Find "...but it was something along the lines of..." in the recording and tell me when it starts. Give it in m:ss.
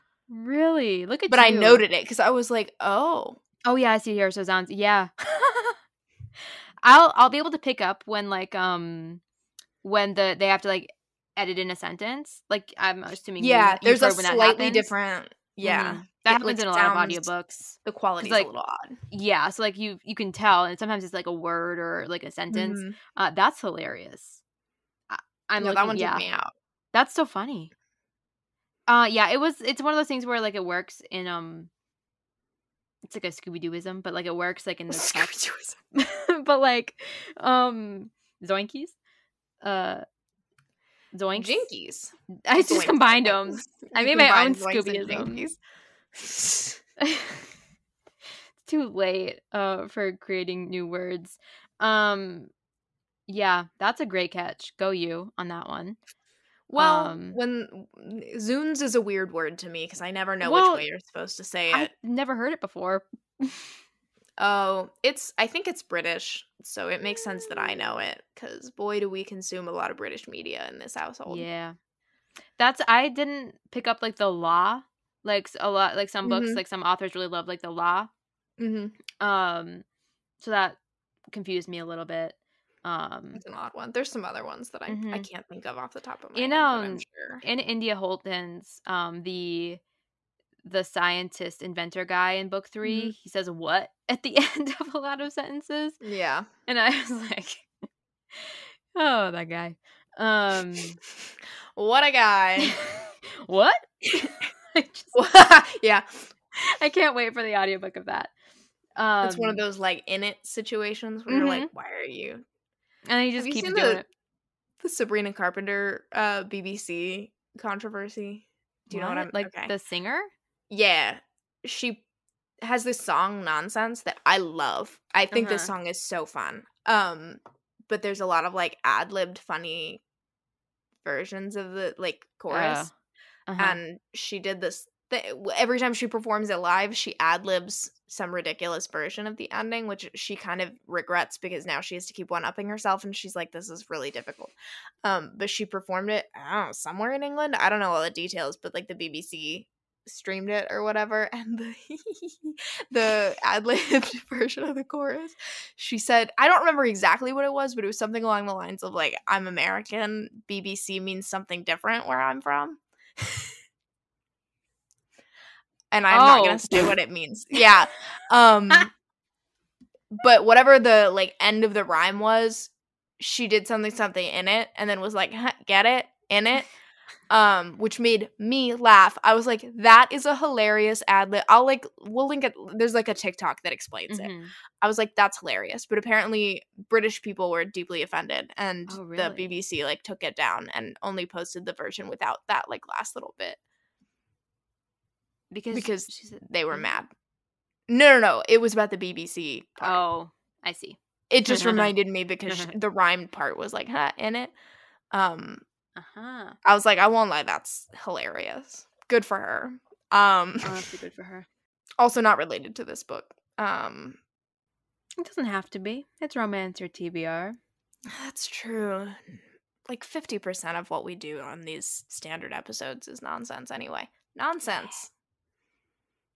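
2:37.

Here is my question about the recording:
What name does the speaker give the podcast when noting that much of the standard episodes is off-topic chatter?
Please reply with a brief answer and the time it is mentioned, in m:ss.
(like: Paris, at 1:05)
Romance Your TBR, at 3:36.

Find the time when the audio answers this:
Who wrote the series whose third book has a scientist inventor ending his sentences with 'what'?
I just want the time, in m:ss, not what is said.
1:27.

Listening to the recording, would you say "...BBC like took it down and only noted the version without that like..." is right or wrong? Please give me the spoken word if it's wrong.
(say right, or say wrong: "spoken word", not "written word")
wrong: "posted", not "noted".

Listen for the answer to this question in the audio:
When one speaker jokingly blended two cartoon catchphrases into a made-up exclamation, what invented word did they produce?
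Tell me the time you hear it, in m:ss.
0:38.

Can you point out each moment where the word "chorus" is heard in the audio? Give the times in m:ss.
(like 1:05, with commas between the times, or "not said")
2:12, 2:34.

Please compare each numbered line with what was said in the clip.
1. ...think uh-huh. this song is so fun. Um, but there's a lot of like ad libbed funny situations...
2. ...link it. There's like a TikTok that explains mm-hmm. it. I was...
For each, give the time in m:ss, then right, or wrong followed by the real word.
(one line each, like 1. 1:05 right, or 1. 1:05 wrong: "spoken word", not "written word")
1. 2:05 wrong: "versions", not "situations"
2. 3:02 right.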